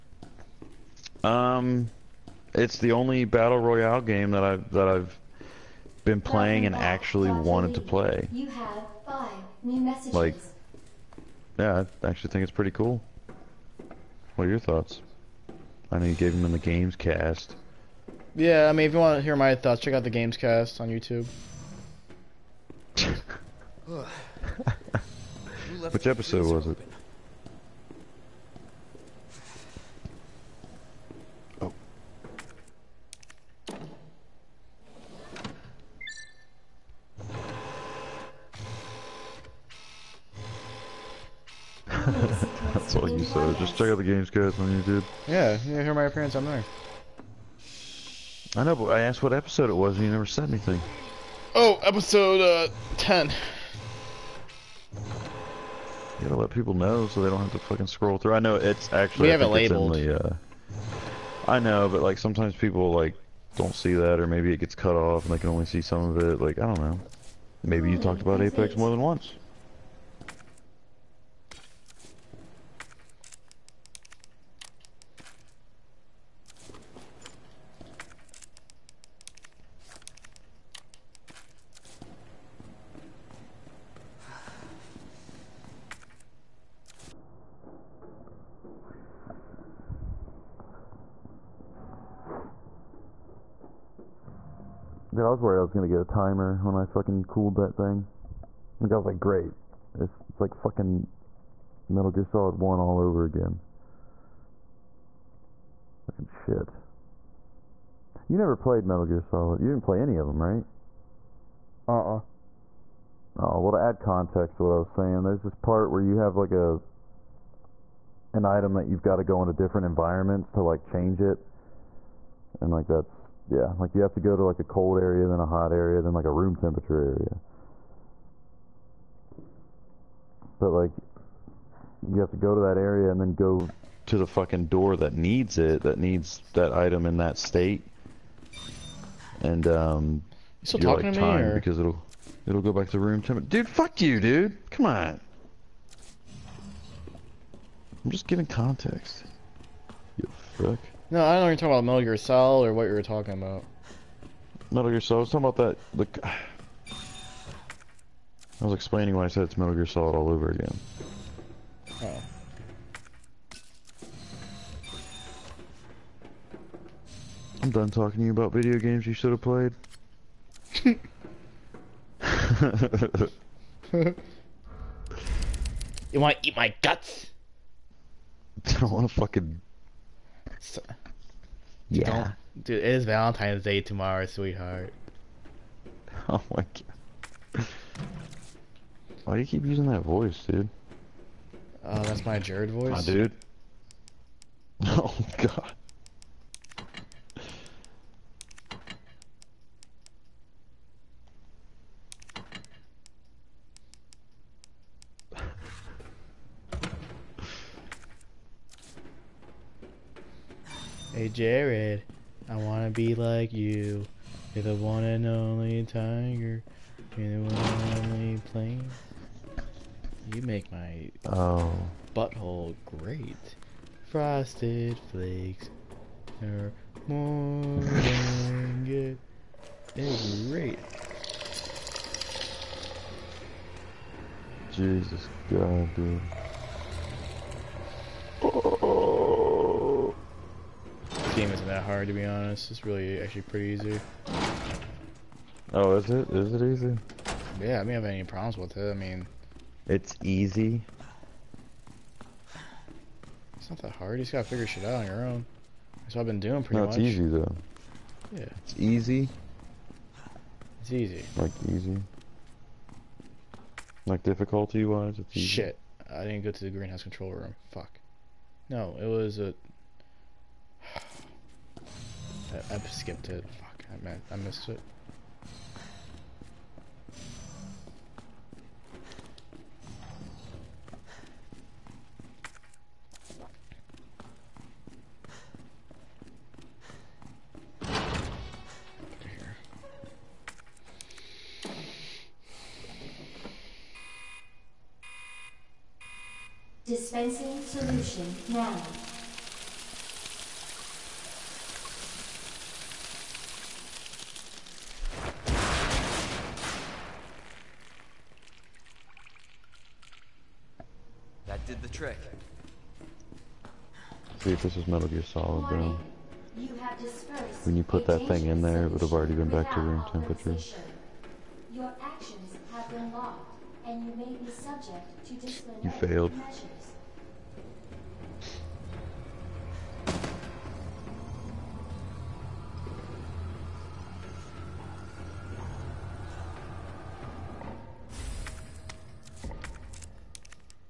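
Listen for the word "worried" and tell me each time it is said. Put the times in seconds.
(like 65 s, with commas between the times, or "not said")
95 s.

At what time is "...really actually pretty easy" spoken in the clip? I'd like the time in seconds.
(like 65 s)
242 s.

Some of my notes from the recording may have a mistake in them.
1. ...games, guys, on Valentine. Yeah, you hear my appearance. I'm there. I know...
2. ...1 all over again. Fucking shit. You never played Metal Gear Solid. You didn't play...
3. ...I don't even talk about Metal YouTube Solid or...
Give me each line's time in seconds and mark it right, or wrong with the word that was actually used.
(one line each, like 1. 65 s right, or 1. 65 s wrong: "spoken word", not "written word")
1. 44 s wrong: "YouTube", not "Valentine"
2. 102 s right
3. 151 s wrong: "Gear", not "YouTube".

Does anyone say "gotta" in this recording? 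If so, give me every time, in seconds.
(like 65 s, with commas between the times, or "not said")
56 s, 254 s.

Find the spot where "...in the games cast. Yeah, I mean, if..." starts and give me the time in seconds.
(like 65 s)
16 s.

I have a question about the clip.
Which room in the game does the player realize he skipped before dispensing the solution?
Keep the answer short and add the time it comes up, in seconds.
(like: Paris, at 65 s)
greenhouse control room, at 266 s.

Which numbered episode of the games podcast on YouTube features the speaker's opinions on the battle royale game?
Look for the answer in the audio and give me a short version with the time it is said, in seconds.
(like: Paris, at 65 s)
10, at 52 s.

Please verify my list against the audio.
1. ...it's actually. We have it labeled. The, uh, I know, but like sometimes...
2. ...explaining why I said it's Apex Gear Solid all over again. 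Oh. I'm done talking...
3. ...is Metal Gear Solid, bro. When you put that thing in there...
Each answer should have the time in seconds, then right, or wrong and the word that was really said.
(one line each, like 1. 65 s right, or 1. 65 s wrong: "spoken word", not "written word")
1. 58 s right
2. 158 s wrong: "Metal", not "Apex"
3. 314 s right.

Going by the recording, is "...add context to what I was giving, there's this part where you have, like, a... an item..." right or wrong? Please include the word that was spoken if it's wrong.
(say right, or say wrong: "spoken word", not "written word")
wrong: "saying", not "giving".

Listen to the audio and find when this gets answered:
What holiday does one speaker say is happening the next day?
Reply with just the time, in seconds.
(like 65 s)
183 s.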